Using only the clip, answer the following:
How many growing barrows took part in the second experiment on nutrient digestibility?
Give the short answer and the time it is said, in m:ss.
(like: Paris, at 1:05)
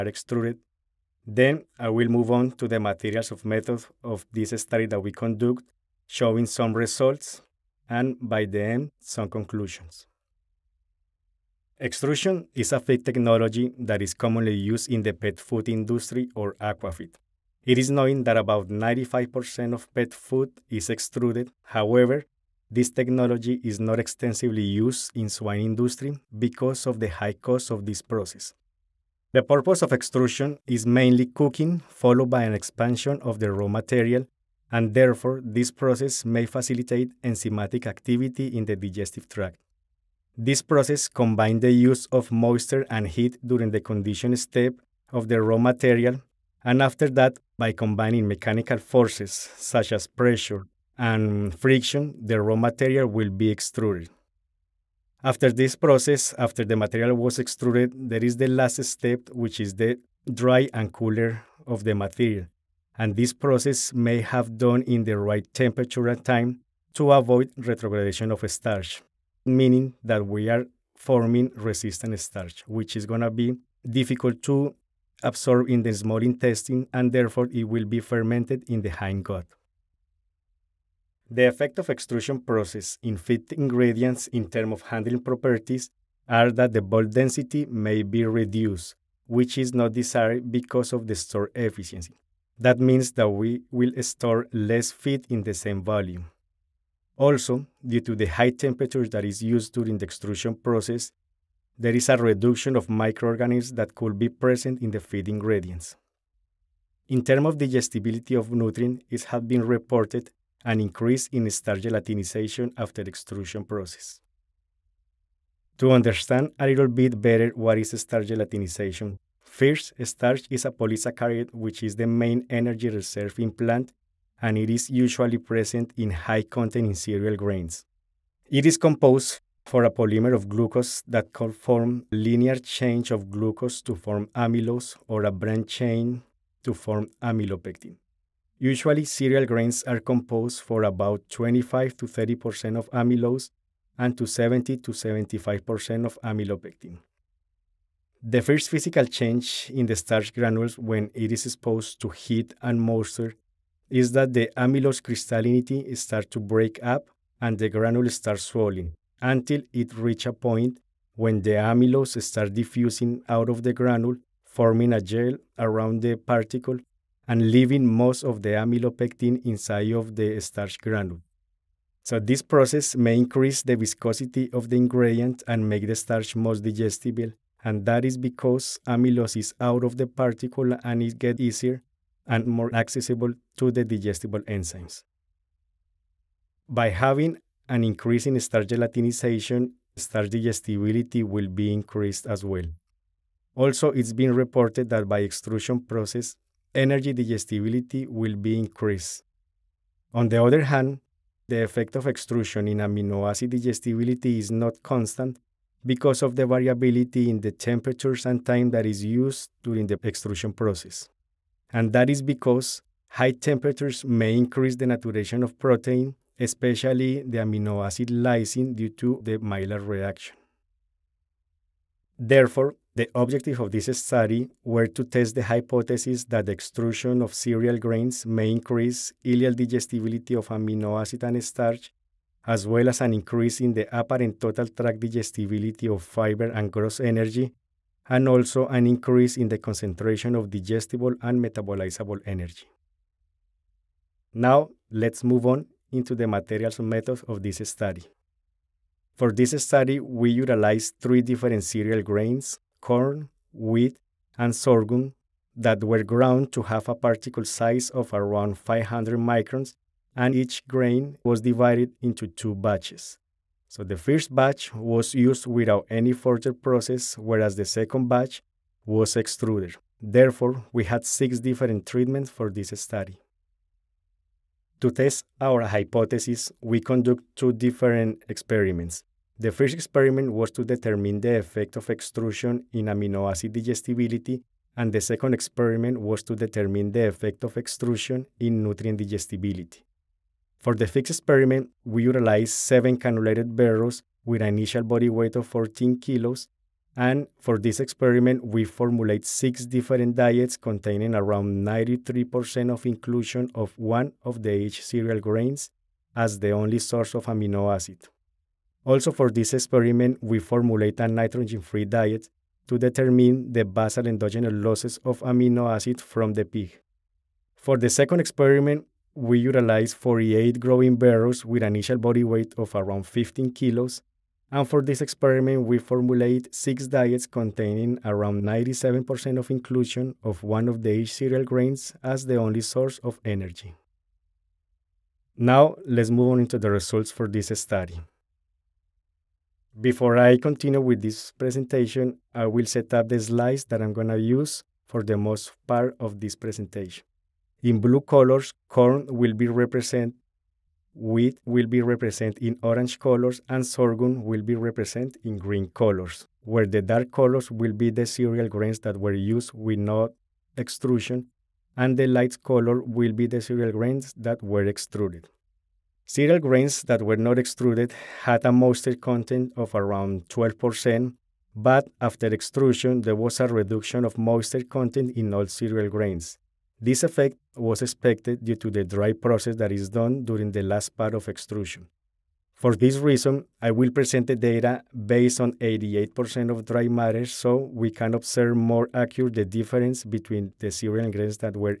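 48, at 5:19.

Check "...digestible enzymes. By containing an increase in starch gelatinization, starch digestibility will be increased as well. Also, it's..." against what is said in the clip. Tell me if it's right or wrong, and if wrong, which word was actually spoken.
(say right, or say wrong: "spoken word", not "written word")
wrong: "having", not "containing".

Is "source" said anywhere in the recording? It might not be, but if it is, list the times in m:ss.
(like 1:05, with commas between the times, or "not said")
5:06, 5:32.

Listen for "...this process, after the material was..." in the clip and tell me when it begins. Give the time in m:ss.
0:55.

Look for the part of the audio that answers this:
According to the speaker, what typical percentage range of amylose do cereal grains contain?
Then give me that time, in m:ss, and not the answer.
2:21.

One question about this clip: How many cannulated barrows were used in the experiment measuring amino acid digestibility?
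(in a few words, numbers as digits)
7.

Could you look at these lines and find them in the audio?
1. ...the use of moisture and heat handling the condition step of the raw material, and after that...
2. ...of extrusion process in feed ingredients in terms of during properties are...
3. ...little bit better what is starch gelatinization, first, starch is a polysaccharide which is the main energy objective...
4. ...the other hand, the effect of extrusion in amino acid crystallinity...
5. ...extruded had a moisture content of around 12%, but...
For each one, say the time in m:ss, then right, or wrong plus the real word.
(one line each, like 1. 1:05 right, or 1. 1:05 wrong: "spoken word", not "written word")
1. 0:41 wrong: "during", not "handling"
2. 1:21 wrong: "handling", not "during"
3. 1:56 wrong: "reserve", not "objective"
4. 3:20 wrong: "digestibility", not "crystallinity"
5. 6:07 right.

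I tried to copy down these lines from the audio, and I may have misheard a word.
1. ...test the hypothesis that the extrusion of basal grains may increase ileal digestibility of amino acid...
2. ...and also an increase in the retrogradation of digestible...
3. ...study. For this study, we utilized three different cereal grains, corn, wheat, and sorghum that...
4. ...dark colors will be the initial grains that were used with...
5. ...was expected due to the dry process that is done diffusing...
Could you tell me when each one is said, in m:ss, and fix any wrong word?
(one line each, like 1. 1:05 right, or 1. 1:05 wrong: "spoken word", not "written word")
1. 3:45 wrong: "cereal", not "basal"
2. 3:58 wrong: "concentration", not "retrogradation"
3. 4:07 right
4. 5:56 wrong: "cereal", not "initial"
5. 6:17 wrong: "during", not "diffusing".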